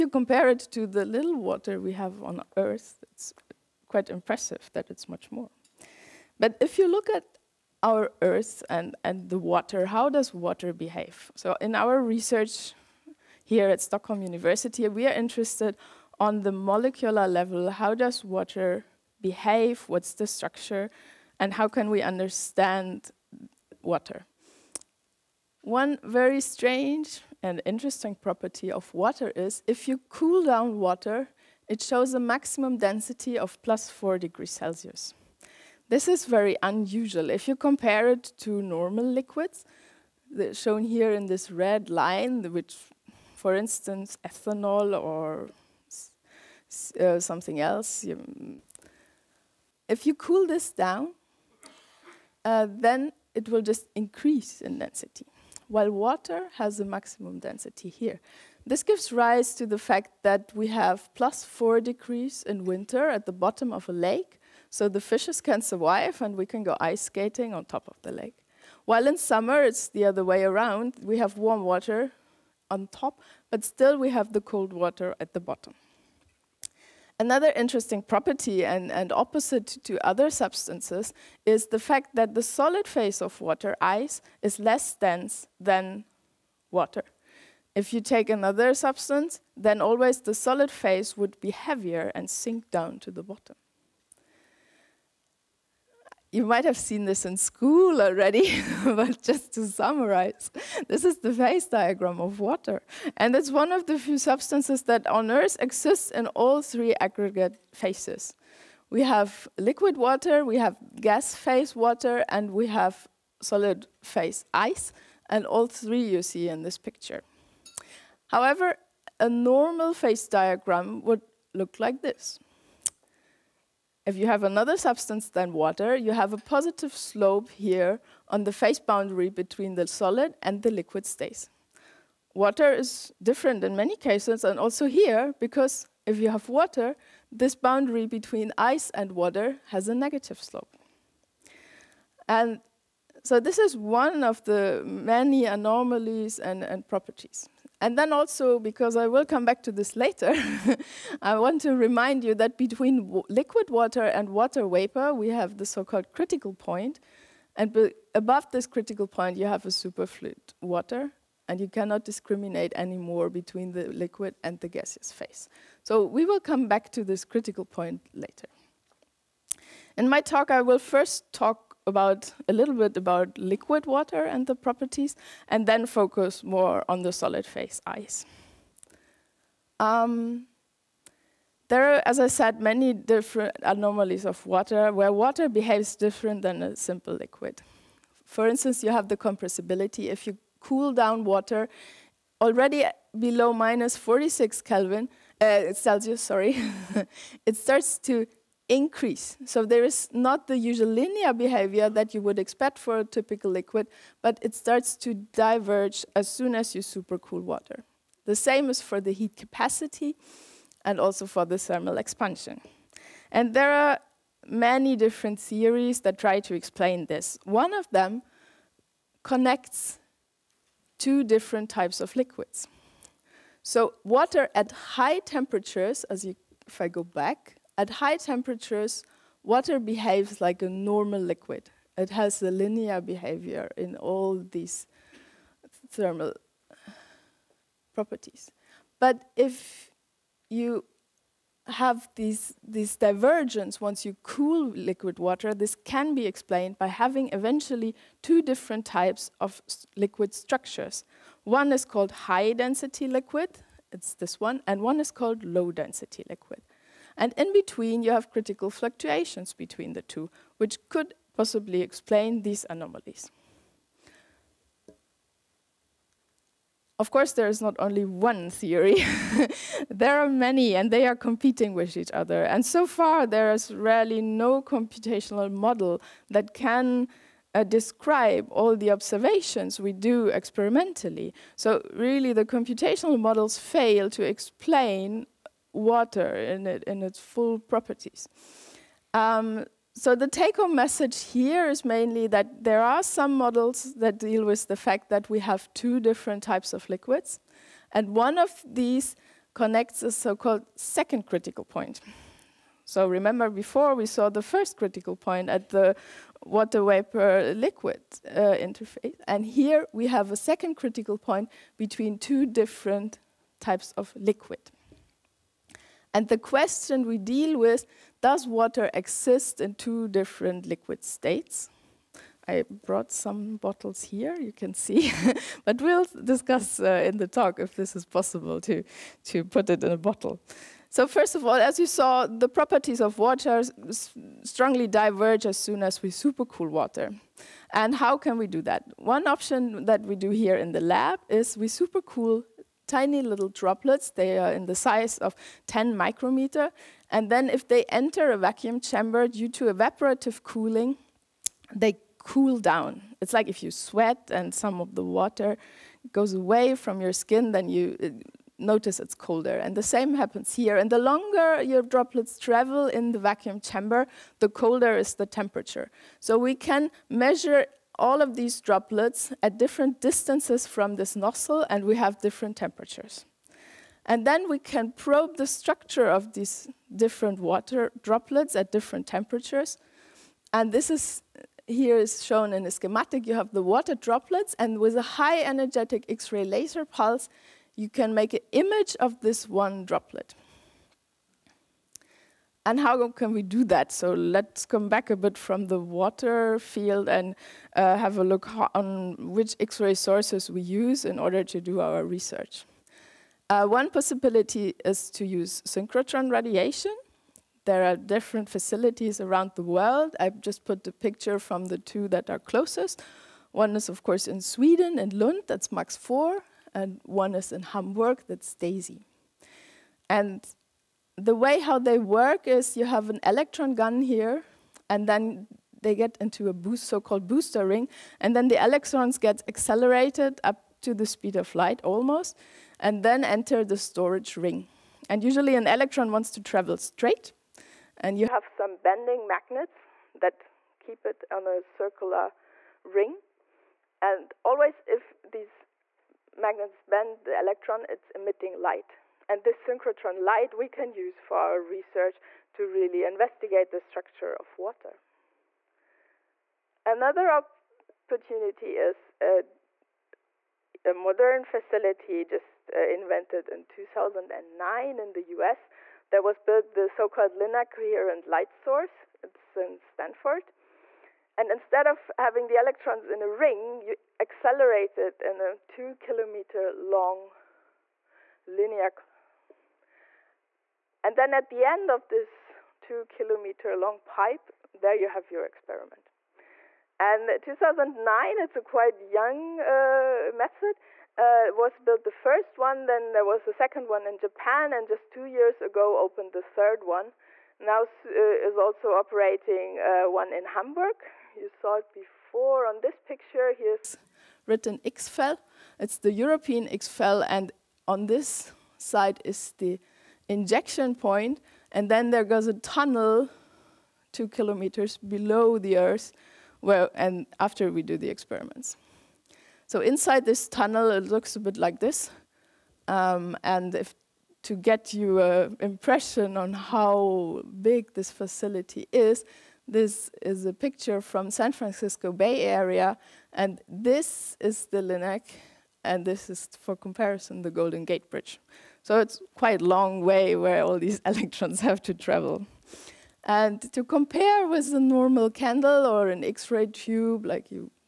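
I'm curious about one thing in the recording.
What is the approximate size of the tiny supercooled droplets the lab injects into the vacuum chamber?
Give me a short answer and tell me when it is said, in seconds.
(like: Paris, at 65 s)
10 micrometers, at 345 s.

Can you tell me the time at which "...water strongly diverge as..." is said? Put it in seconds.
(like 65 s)
333 s.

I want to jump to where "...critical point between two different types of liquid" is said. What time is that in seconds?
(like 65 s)
310 s.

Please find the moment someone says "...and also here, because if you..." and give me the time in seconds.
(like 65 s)
134 s.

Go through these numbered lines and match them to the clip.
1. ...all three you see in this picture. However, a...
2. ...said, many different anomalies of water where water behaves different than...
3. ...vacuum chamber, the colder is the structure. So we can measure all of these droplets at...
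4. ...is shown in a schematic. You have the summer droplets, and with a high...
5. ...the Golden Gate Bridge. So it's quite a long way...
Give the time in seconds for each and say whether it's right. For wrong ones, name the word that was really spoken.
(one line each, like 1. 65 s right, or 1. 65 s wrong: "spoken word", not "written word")
1. 115 s right
2. 182 s right
3. 363 s wrong: "temperature", not "structure"
4. 381 s wrong: "water", not "summer"
5. 537 s right.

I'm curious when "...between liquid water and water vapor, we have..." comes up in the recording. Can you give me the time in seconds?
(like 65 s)
152 s.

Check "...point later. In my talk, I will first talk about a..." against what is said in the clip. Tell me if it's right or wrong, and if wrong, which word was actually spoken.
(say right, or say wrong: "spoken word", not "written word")
right.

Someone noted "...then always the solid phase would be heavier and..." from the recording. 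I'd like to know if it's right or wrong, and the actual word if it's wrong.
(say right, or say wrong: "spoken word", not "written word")
right.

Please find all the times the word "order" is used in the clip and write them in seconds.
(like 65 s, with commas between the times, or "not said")
401 s.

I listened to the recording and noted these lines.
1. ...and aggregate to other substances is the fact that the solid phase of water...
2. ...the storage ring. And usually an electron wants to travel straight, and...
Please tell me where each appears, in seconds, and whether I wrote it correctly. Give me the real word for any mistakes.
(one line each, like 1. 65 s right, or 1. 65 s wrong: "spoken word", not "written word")
1. 78 s wrong: "opposite", not "aggregate"
2. 433 s right.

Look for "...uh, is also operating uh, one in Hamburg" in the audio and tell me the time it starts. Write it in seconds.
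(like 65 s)
497 s.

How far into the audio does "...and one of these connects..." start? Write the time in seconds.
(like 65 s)
297 s.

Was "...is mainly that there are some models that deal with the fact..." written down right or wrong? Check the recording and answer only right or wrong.
right.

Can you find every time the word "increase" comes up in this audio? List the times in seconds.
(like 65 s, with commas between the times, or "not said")
53 s, 198 s.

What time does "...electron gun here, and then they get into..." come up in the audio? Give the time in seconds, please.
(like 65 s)
423 s.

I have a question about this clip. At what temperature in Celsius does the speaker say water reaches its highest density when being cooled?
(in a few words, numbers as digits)
4 degrees Celsius.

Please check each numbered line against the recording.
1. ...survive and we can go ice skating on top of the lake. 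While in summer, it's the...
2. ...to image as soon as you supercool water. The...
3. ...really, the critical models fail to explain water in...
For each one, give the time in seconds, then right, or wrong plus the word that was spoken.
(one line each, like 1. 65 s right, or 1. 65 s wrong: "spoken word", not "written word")
1. 65 s right
2. 204 s wrong: "diverge", not "image"
3. 281 s wrong: "computational", not "critical".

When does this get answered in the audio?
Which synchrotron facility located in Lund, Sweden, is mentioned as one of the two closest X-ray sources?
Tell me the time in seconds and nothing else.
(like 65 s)
415 s.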